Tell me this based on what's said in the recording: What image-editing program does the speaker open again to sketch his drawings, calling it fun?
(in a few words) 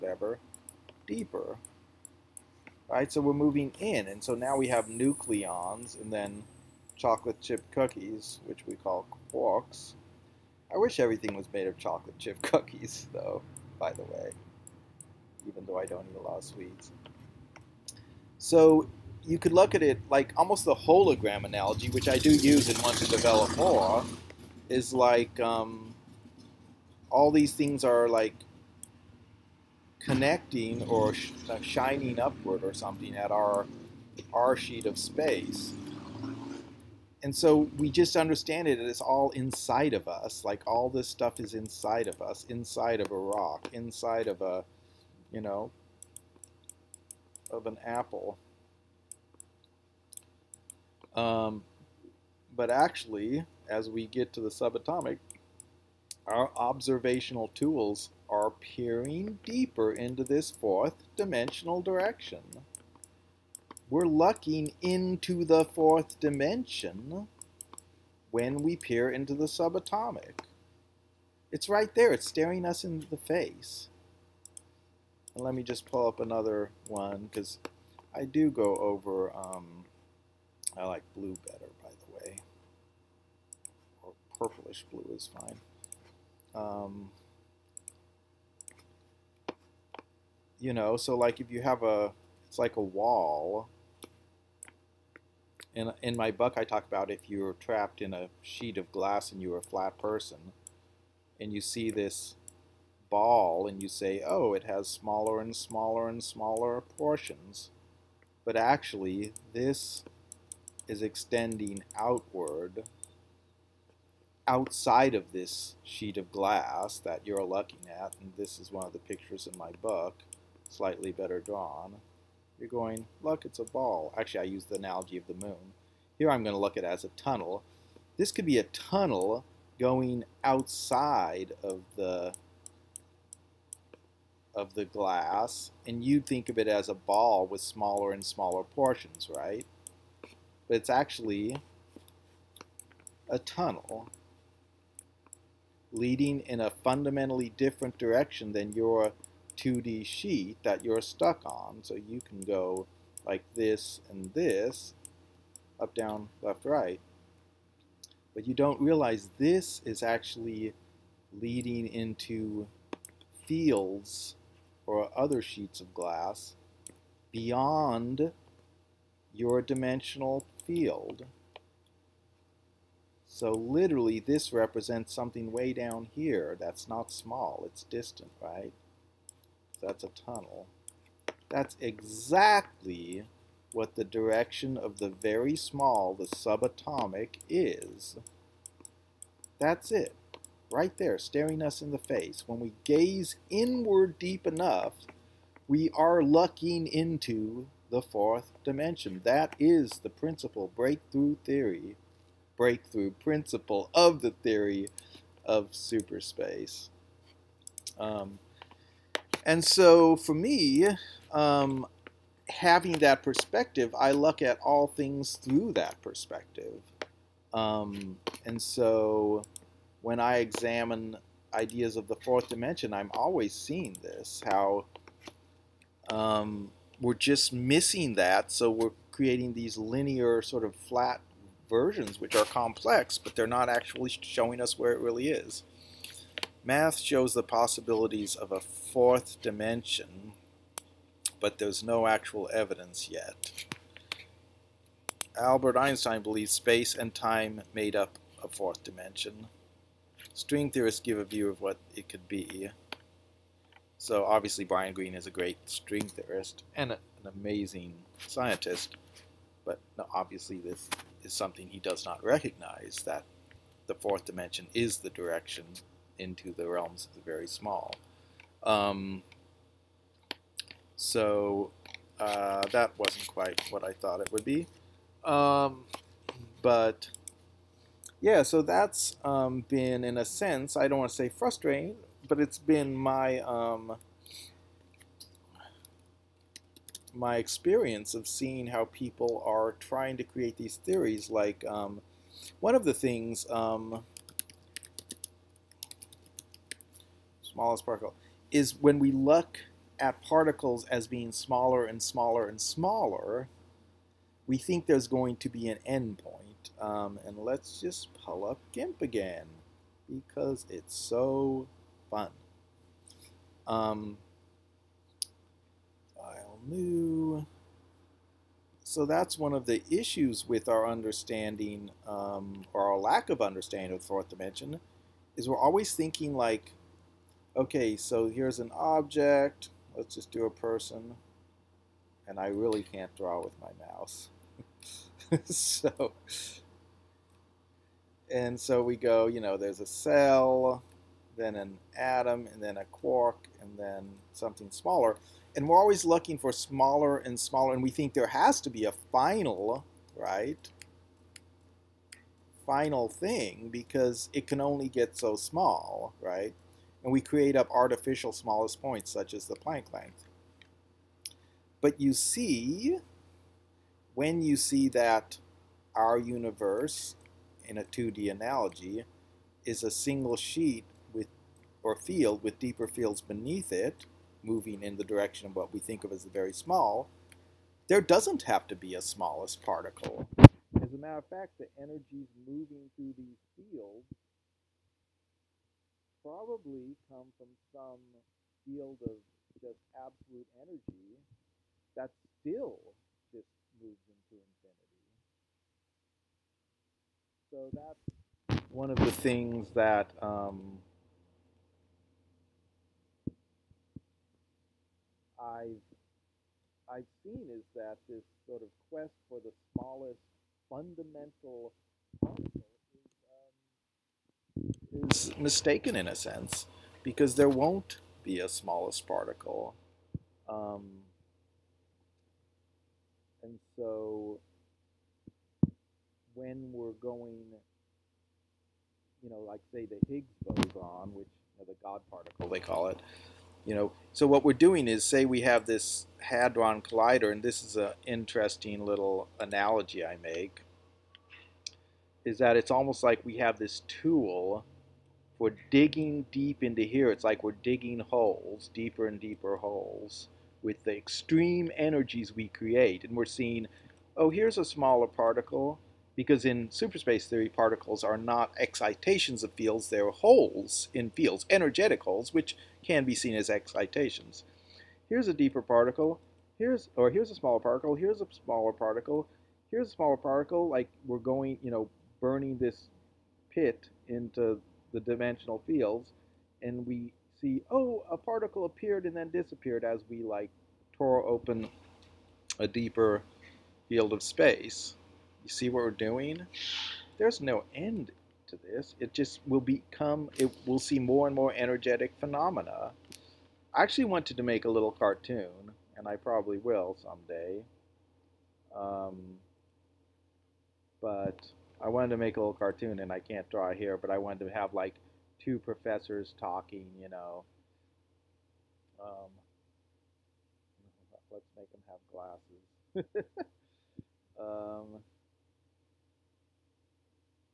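GIMP.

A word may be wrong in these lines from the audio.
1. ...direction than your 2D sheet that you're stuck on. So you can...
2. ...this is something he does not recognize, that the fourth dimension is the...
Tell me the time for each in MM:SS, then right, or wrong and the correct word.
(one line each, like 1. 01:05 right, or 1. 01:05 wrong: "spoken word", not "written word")
1. 02:27 right
2. 04:20 right.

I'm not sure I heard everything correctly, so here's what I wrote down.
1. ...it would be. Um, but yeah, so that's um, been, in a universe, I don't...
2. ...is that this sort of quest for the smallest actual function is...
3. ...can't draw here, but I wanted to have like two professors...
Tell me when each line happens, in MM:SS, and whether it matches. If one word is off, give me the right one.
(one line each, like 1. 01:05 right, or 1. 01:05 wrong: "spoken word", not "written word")
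1. 04:34 wrong: "sense", not "universe"
2. 06:47 wrong: "fundamental", not "actual"
3. 08:23 right.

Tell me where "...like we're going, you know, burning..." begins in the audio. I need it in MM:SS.
07:50.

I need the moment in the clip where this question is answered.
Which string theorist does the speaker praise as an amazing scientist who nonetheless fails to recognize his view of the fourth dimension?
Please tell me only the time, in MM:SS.
04:14.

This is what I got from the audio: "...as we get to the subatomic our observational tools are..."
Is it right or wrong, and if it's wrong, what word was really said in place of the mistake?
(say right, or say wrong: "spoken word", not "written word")
right.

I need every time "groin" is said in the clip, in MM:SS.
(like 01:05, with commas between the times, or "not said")
not said.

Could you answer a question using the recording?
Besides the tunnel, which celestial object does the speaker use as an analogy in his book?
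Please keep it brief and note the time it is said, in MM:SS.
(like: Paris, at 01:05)
the moon, at 02:05.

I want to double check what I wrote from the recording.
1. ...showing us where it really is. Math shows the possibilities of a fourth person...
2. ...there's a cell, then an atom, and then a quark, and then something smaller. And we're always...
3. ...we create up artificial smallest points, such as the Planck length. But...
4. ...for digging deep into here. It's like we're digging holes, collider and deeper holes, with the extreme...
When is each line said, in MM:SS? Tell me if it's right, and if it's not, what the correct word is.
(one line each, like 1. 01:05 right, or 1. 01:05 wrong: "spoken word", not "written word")
1. 03:54 wrong: "dimension", not "person"
2. 05:39 right
3. 05:57 right
4. 07:25 wrong: "deeper", not "collider".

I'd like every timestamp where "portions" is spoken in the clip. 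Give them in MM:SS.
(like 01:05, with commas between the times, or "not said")
01:46, 02:18.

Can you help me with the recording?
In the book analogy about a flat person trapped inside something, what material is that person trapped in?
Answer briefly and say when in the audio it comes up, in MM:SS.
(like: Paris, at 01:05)
a sheet of glass, at 01:38.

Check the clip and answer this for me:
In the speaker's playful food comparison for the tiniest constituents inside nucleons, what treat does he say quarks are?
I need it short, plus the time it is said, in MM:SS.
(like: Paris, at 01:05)
chocolate chip cookies, at 00:06.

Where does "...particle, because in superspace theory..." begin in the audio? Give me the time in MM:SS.
07:35.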